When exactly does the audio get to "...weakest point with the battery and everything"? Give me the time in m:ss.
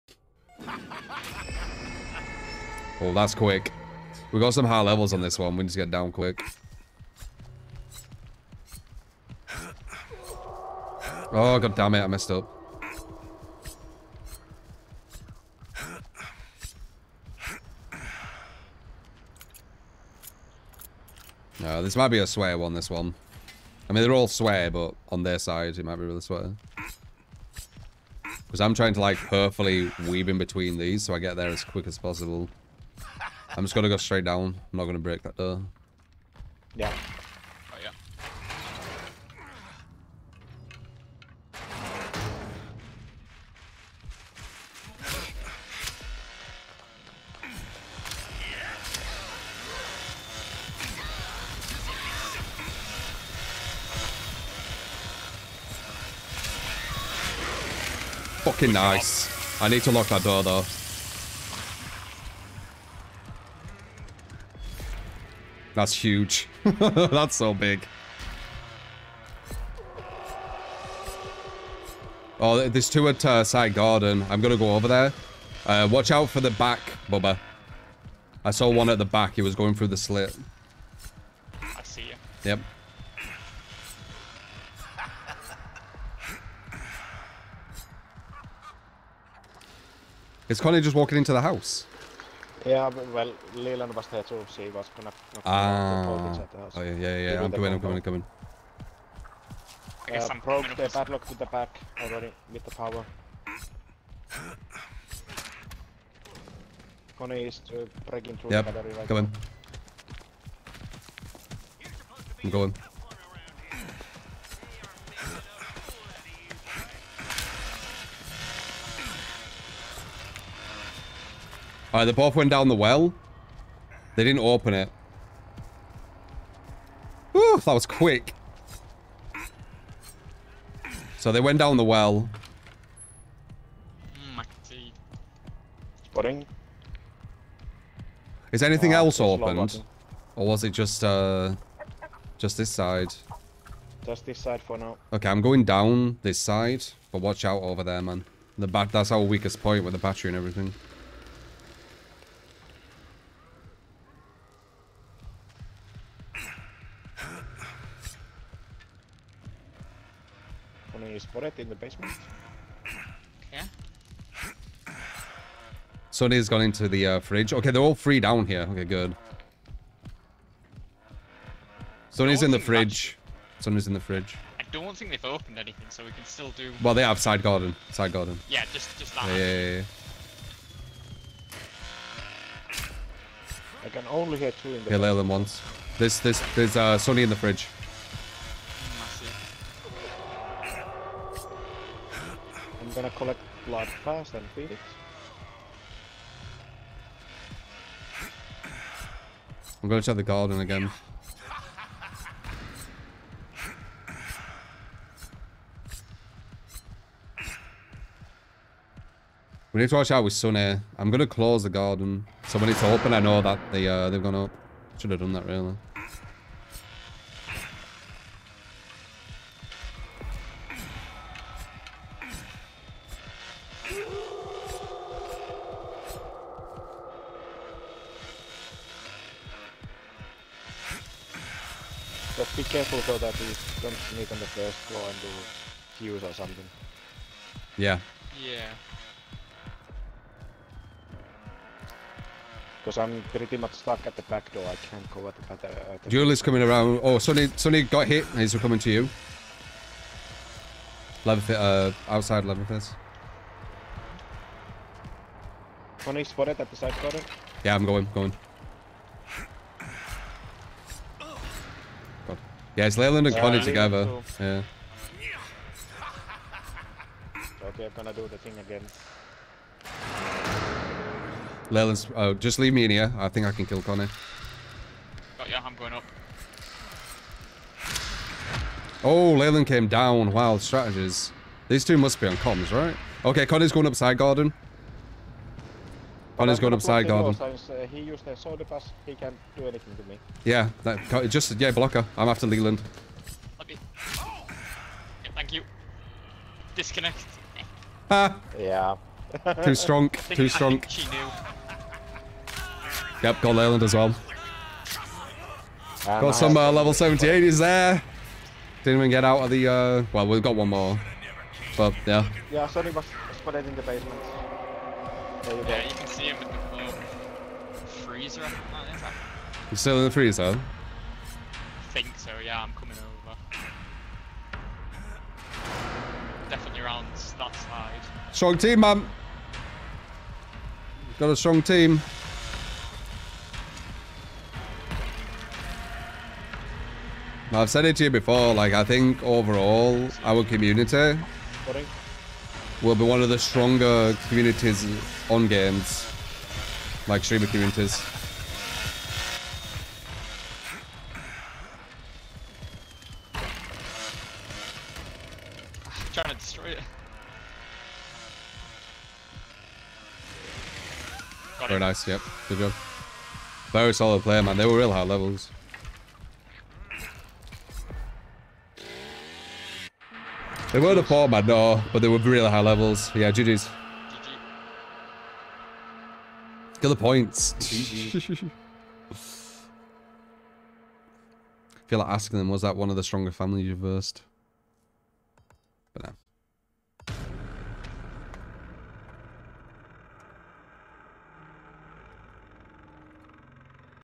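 2:29.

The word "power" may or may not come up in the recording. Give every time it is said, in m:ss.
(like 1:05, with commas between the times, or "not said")
1:42.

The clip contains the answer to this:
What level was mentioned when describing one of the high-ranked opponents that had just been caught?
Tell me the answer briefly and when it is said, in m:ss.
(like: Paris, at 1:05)
78, at 5:06.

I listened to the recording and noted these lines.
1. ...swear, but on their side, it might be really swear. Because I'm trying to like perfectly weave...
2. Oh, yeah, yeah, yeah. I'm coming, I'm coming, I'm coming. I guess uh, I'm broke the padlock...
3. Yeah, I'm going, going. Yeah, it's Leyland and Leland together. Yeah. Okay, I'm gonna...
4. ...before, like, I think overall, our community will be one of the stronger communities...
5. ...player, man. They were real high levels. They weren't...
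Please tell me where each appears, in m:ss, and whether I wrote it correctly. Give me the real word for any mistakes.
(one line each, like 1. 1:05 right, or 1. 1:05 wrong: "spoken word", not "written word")
1. 0:24 right
2. 1:36 right
3. 4:17 wrong: "Connie", not "Leland"
4. 5:38 right
5. 6:04 right.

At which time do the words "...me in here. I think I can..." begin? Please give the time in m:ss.
4:32.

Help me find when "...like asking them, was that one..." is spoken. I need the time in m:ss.
6:21.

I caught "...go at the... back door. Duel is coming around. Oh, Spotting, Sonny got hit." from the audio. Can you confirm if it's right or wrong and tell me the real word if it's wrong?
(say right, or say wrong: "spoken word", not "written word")
wrong: "Sonny", not "Spotting".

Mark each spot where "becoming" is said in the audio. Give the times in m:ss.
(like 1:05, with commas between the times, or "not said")
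not said.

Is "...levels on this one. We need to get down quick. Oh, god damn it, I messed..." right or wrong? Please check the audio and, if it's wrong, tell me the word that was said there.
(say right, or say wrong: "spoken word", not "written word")
right.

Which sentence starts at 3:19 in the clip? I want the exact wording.
I'm gonna try the garden again.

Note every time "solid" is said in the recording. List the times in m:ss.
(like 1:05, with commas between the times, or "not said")
6:03.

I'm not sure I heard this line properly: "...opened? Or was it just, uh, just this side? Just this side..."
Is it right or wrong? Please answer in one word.
right.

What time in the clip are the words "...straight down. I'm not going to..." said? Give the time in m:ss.
0:33.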